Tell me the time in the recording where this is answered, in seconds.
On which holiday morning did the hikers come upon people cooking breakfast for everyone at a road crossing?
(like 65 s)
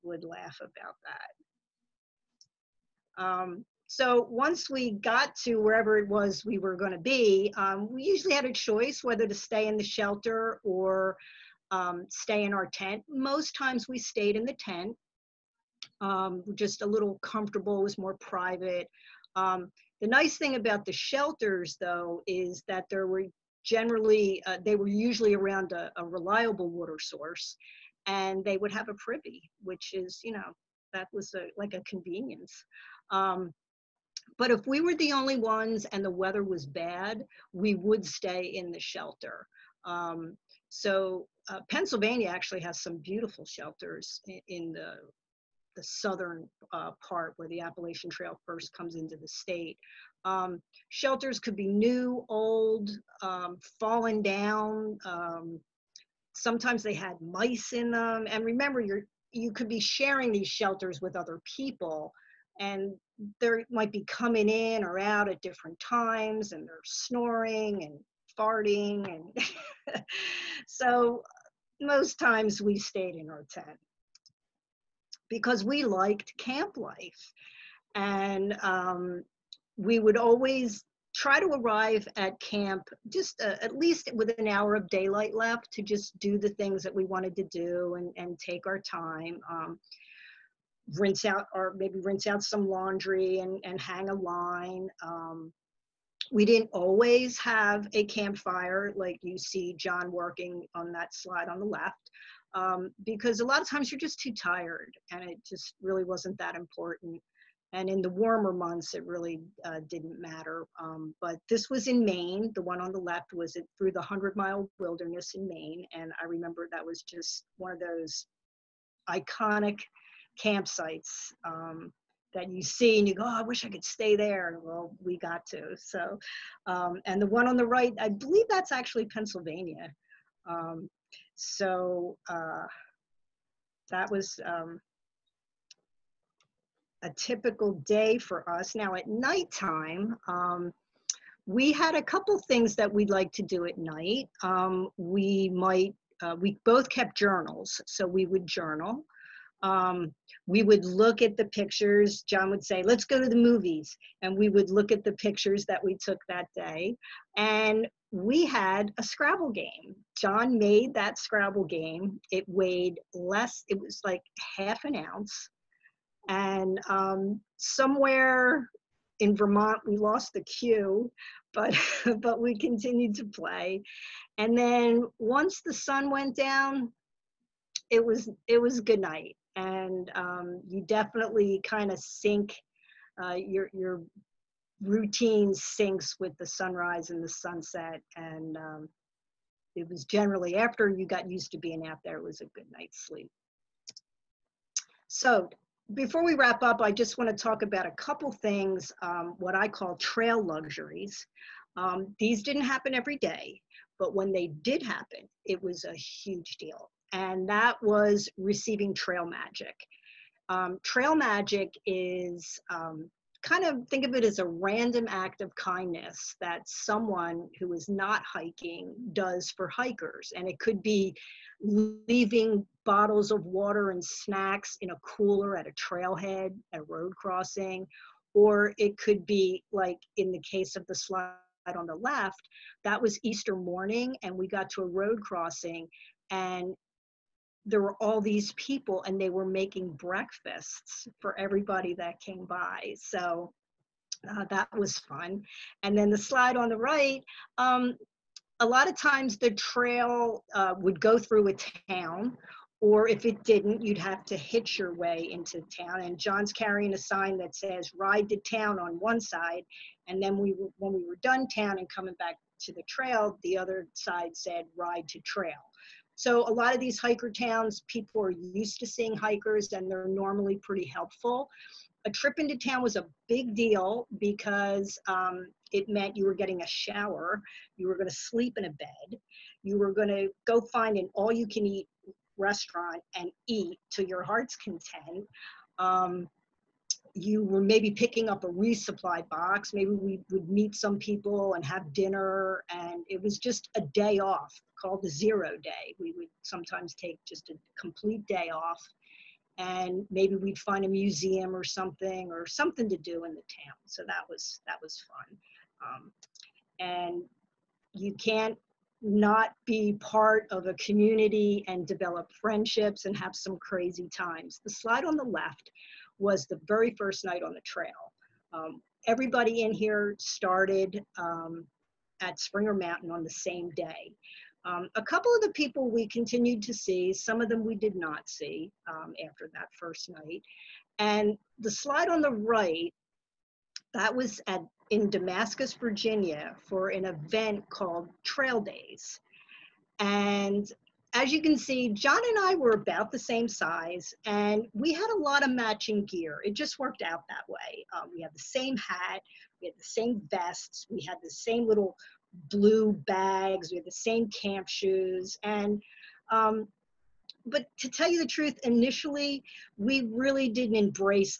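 233 s.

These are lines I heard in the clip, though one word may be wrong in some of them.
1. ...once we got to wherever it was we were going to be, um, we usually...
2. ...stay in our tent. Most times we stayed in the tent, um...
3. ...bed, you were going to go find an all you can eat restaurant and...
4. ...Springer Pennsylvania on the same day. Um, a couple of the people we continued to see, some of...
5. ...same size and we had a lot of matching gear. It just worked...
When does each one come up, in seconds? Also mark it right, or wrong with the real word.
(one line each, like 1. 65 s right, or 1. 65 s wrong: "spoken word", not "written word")
1. 4 s right
2. 12 s right
3. 278 s right
4. 322 s wrong: "Mountain", not "Pennsylvania"
5. 343 s right.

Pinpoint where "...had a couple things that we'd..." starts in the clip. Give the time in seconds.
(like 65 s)
141 s.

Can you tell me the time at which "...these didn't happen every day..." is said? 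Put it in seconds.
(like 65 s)
202 s.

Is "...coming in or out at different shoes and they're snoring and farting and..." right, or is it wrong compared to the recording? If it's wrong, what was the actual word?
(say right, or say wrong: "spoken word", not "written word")
wrong: "times", not "shoes".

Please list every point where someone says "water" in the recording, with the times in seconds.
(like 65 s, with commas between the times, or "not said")
26 s, 223 s.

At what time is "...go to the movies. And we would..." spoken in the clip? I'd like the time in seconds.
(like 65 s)
153 s.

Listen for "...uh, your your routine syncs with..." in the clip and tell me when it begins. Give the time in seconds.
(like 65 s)
183 s.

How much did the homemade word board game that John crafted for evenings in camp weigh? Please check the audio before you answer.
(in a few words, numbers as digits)
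Half an ounce.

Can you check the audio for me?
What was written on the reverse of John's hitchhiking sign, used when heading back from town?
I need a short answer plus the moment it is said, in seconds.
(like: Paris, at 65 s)
Ride to Trail, at 264 s.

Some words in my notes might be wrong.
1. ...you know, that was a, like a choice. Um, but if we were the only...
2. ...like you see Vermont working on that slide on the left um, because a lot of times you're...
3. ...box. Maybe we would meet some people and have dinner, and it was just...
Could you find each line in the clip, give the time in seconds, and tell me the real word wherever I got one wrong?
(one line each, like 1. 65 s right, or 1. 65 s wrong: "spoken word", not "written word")
1. 30 s wrong: "convenience", not "choice"
2. 98 s wrong: "John", not "Vermont"
3. 289 s right.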